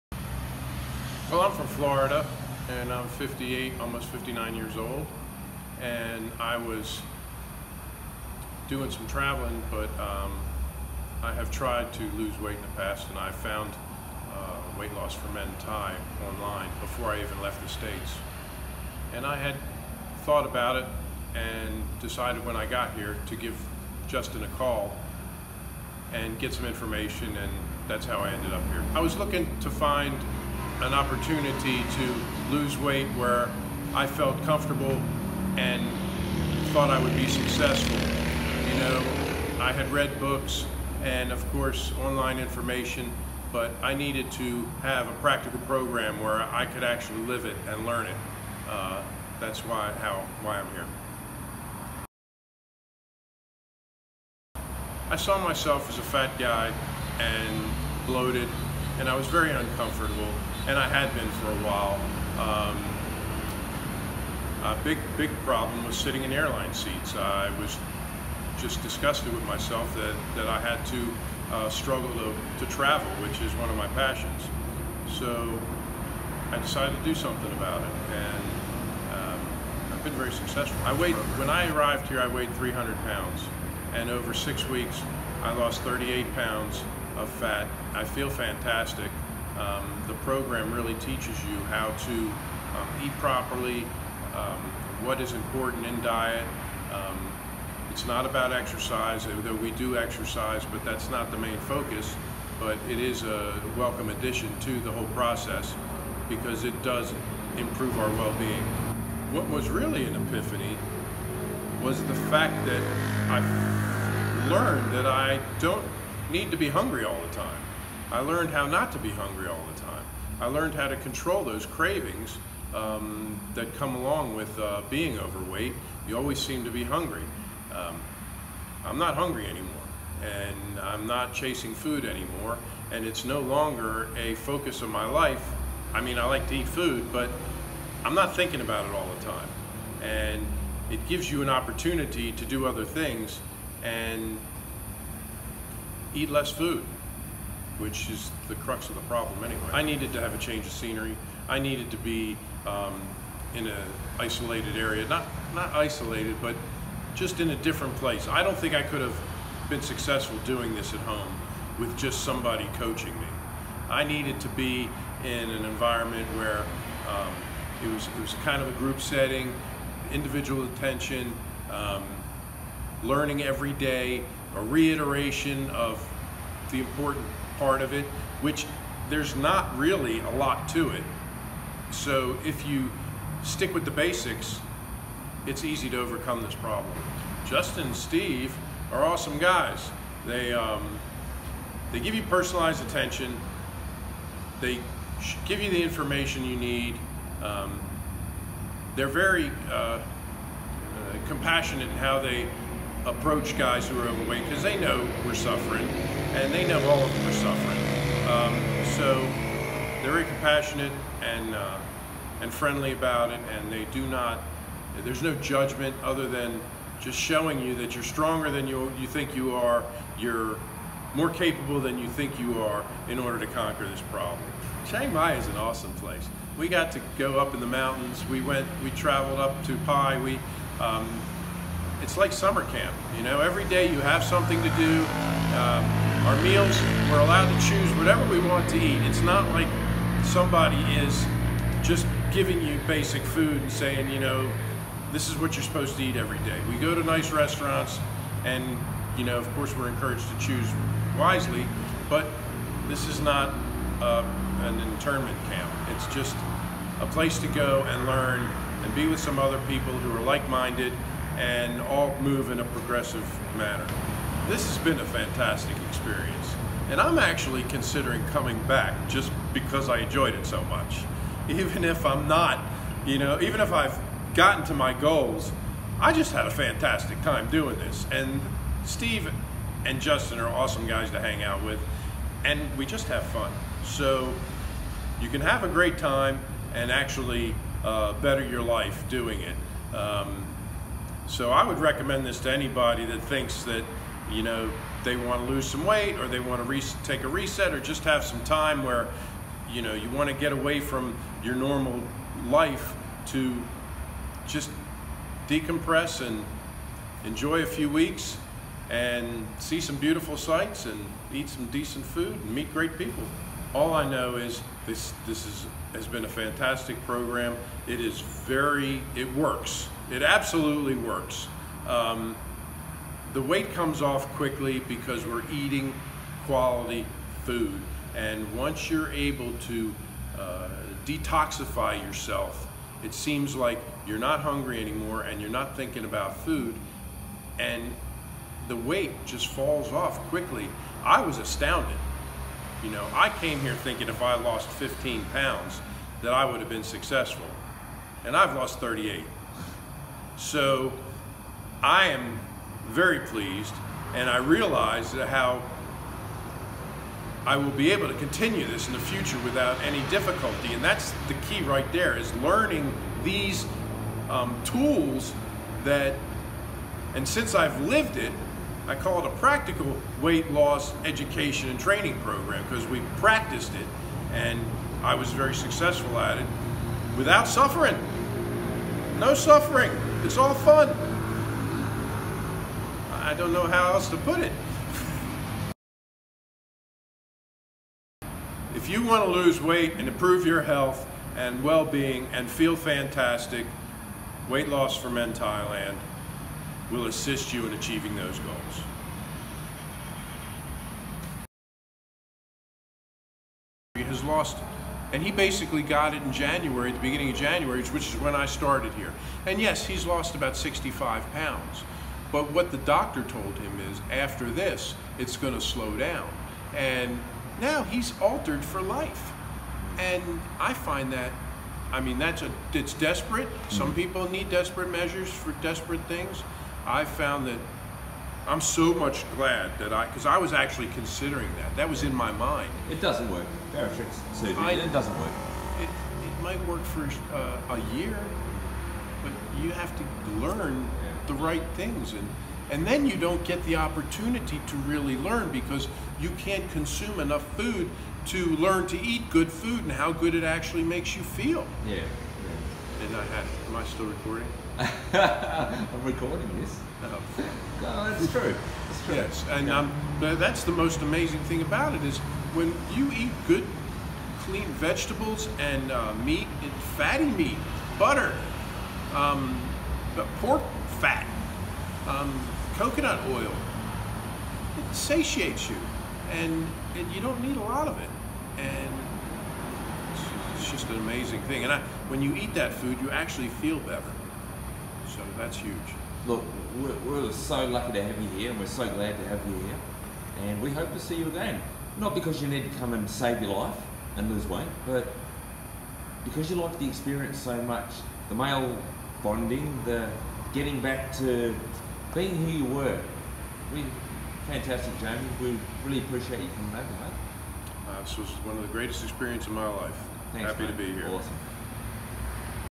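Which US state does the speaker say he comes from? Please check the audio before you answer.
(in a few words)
Florida.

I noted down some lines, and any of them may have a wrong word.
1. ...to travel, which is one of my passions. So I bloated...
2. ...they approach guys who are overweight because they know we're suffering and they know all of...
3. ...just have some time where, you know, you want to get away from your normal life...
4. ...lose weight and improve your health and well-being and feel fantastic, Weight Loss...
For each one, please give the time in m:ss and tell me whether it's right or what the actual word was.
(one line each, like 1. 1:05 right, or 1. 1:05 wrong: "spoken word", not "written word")
1. 1:12 wrong: "decided", not "bloated"
2. 3:22 right
3. 4:57 right
4. 6:29 right.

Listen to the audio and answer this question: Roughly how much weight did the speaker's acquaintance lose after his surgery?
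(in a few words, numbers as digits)
65 pounds.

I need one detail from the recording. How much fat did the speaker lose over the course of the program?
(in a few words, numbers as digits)
38 pounds.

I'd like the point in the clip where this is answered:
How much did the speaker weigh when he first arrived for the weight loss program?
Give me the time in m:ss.
1:22.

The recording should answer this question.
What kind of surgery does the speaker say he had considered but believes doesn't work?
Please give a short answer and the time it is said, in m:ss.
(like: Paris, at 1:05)
Bariatric surgery, at 7:13.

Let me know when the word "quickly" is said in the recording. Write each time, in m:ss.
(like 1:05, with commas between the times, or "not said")
5:24, 5:40.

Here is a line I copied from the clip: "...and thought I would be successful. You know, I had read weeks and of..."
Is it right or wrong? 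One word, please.
wrong.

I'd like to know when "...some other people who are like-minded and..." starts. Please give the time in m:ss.
4:19.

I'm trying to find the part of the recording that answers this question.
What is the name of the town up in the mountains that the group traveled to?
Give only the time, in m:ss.
3:49.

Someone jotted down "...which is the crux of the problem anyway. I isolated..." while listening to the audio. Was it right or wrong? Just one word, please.
wrong.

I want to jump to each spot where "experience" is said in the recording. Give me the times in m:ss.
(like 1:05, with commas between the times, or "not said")
4:25, 8:16, 8:29.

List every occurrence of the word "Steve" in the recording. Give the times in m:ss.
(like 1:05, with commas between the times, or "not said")
3:07, 4:38.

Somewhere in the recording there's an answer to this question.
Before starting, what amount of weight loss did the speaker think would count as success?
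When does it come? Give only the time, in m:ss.
5:44.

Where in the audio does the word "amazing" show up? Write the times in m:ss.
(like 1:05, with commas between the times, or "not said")
7:41, 8:00.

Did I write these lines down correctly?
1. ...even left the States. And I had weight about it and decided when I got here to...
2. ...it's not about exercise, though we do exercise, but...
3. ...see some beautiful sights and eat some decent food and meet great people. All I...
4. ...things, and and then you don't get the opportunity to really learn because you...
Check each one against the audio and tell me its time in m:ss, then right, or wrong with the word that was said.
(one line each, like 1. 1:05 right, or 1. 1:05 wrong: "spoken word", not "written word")
1. 0:17 wrong: "thought", not "weight"
2. 1:37 right
3. 5:09 right
4. 7:21 right.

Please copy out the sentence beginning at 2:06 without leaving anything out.
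You always seem to be hungry.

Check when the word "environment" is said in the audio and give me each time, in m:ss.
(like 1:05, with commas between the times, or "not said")
2:45.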